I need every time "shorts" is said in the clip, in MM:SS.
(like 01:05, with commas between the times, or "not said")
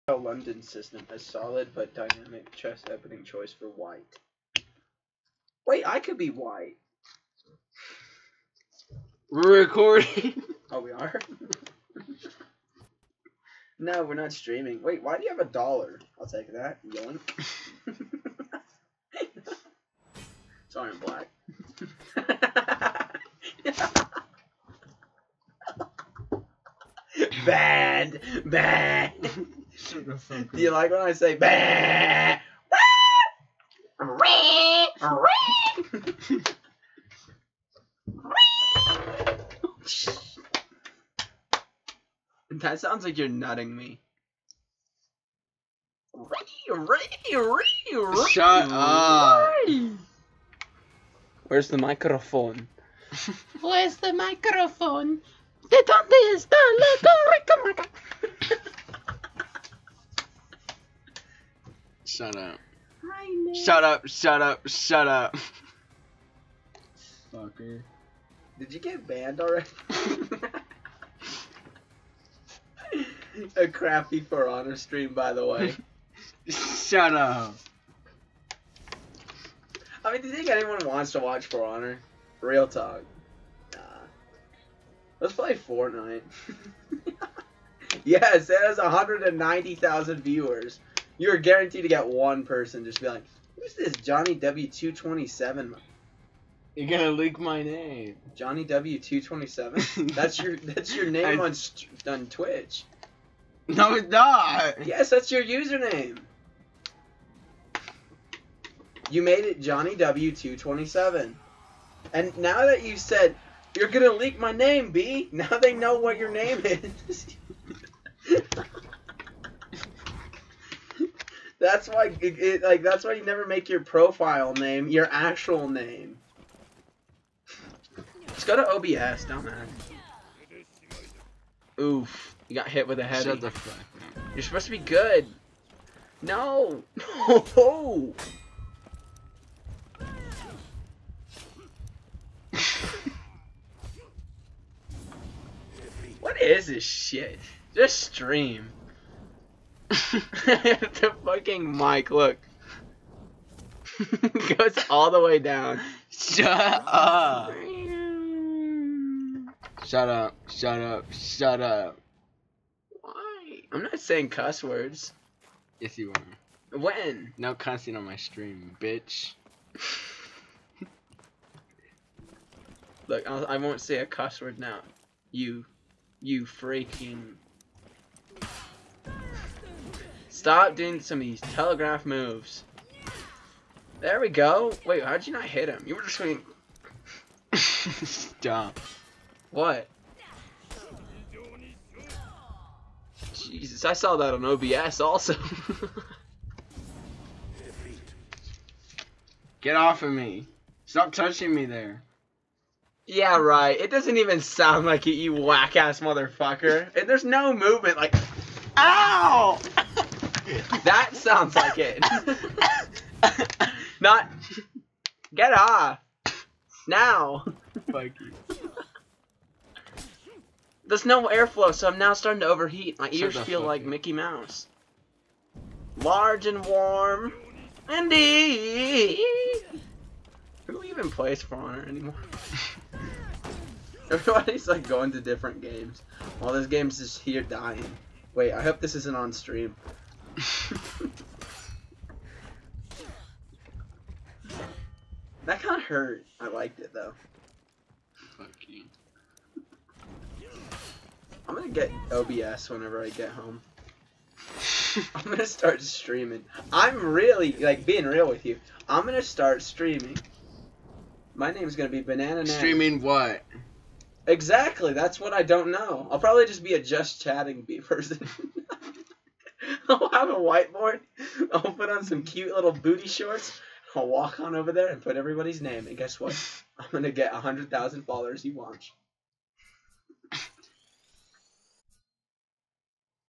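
04:33.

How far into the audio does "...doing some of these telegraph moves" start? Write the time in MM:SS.
03:00.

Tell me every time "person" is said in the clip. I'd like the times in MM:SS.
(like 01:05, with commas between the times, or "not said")
01:32, 04:27.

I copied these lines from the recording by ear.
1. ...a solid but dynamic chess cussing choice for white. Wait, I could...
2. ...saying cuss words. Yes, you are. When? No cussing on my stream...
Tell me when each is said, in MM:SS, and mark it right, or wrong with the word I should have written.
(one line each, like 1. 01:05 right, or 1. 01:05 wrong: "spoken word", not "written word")
1. 00:01 wrong: "opening", not "cussing"
2. 02:43 right.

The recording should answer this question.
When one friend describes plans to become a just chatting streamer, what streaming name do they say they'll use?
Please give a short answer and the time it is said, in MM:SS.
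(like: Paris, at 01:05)
Banana, at 04:22.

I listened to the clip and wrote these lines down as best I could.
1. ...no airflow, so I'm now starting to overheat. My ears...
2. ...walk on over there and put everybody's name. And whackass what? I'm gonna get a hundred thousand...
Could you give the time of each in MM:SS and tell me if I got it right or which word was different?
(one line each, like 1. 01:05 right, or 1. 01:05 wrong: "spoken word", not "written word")
1. 03:41 right
2. 04:34 wrong: "guess", not "whackass".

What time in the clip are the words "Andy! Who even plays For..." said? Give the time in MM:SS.
03:47.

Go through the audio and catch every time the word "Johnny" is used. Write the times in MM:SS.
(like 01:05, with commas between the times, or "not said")
01:34, 01:38, 01:49.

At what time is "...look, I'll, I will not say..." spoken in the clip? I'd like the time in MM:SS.
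02:53.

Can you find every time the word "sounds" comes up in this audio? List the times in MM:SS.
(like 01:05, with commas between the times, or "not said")
00:42, 03:24, 03:31.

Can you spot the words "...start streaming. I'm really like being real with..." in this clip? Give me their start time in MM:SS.
04:15.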